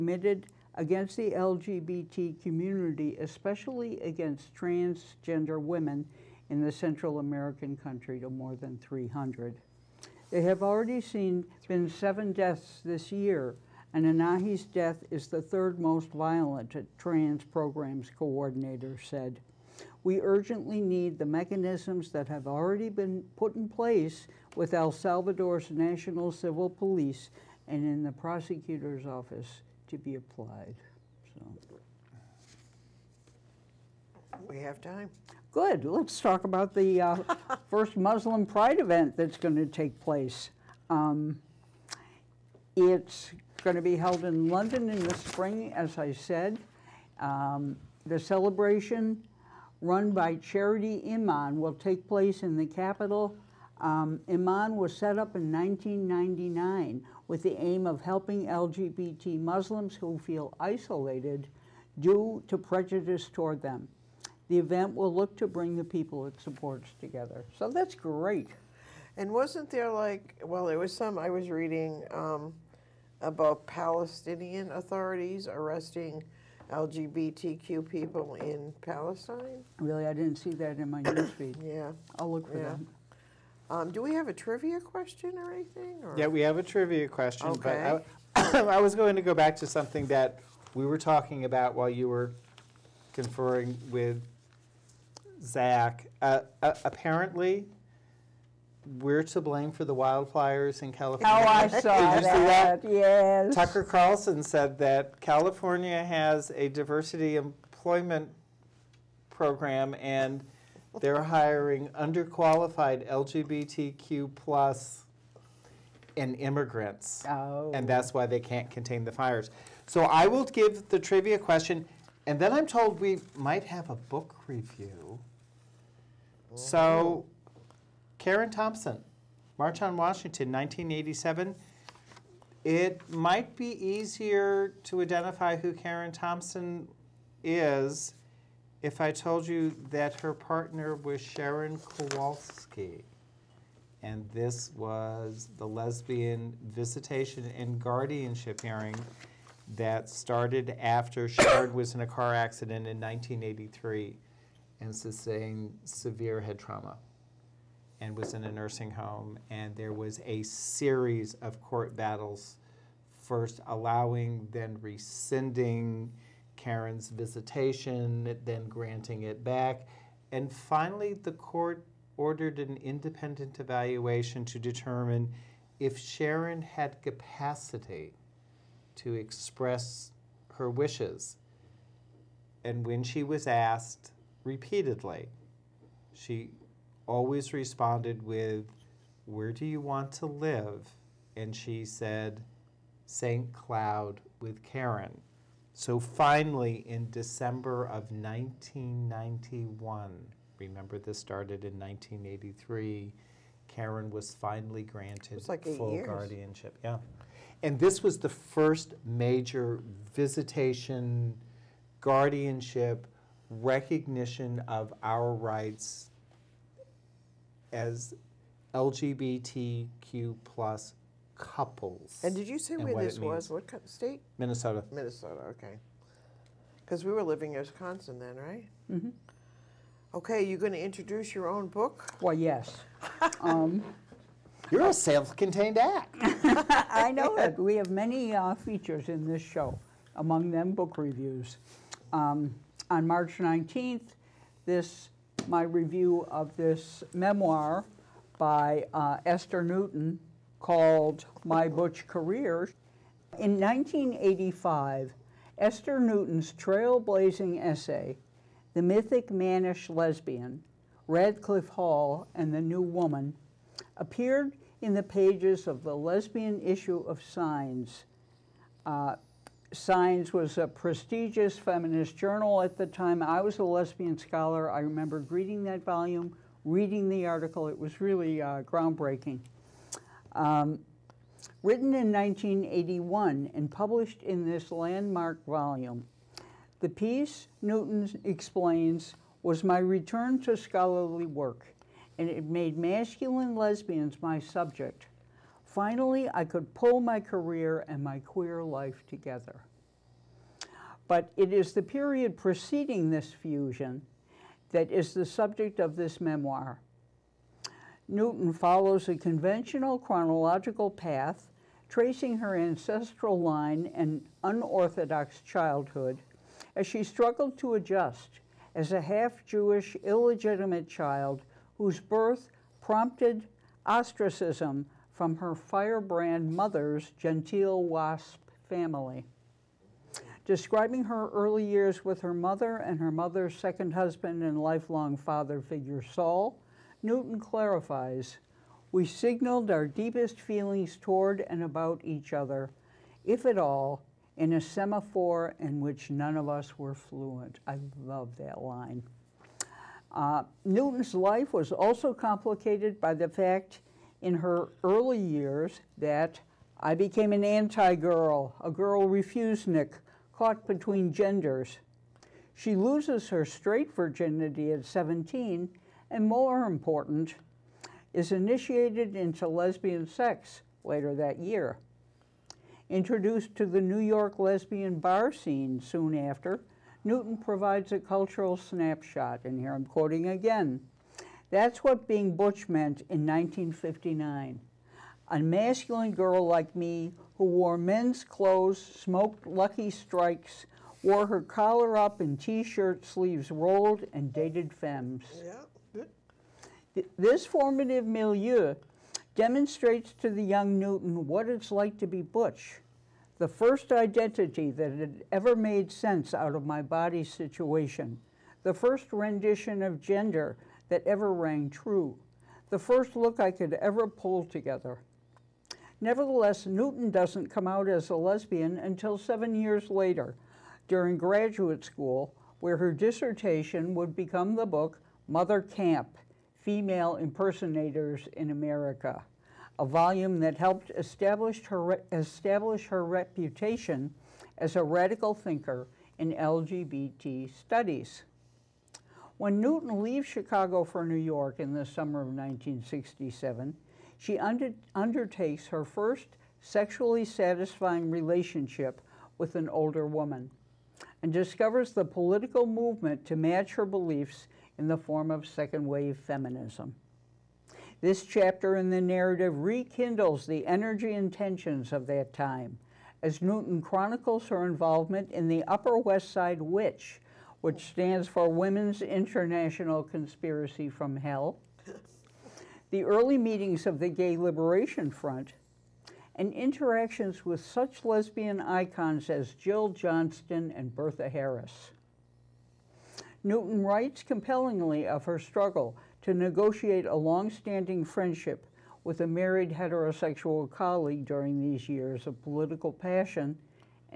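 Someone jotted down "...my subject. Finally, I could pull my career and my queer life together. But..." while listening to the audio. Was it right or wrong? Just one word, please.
right.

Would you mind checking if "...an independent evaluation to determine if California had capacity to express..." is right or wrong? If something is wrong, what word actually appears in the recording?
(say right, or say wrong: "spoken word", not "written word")
wrong: "Sharon", not "California".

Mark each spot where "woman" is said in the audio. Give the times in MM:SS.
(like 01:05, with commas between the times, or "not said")
04:22, 07:30.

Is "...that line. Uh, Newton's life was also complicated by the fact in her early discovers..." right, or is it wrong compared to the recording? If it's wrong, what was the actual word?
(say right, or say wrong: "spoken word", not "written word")
wrong: "years", not "discovers".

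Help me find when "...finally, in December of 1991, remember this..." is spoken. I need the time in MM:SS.
03:15.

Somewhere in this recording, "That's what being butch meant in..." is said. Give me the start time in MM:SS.
06:21.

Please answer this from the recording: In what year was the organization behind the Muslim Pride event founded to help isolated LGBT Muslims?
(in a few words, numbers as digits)
1999.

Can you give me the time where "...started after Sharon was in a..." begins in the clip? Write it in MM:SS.
02:30.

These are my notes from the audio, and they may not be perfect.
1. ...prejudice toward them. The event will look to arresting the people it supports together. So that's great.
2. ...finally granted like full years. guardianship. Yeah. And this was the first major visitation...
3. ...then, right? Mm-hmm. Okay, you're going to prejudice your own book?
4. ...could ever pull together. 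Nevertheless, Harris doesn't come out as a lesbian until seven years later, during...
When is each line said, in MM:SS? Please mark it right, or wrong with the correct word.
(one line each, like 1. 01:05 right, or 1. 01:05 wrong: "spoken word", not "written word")
1. 01:02 wrong: "bring", not "arresting"
2. 03:24 right
3. 03:48 wrong: "introduce", not "prejudice"
4. 06:53 wrong: "Newton", not "Harris".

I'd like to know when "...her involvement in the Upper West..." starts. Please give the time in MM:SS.
07:44.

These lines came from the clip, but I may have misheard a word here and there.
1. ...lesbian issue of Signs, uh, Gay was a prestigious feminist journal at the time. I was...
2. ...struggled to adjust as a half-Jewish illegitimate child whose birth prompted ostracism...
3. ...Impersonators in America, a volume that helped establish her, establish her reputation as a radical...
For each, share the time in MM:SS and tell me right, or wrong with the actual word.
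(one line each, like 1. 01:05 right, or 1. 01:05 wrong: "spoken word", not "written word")
1. 04:25 wrong: "Signs", not "Gay"
2. 05:17 right
3. 07:07 right.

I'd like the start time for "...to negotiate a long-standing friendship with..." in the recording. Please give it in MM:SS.
08:06.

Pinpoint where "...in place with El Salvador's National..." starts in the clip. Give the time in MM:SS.
00:23.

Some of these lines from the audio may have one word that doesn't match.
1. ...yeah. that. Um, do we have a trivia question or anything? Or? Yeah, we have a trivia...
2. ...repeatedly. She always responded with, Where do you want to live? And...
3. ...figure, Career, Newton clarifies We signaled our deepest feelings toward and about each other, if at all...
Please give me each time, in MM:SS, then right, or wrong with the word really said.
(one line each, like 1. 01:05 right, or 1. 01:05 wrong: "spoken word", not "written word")
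1. 01:22 right
2. 03:04 right
3. 05:35 wrong: "Saul", not "Career".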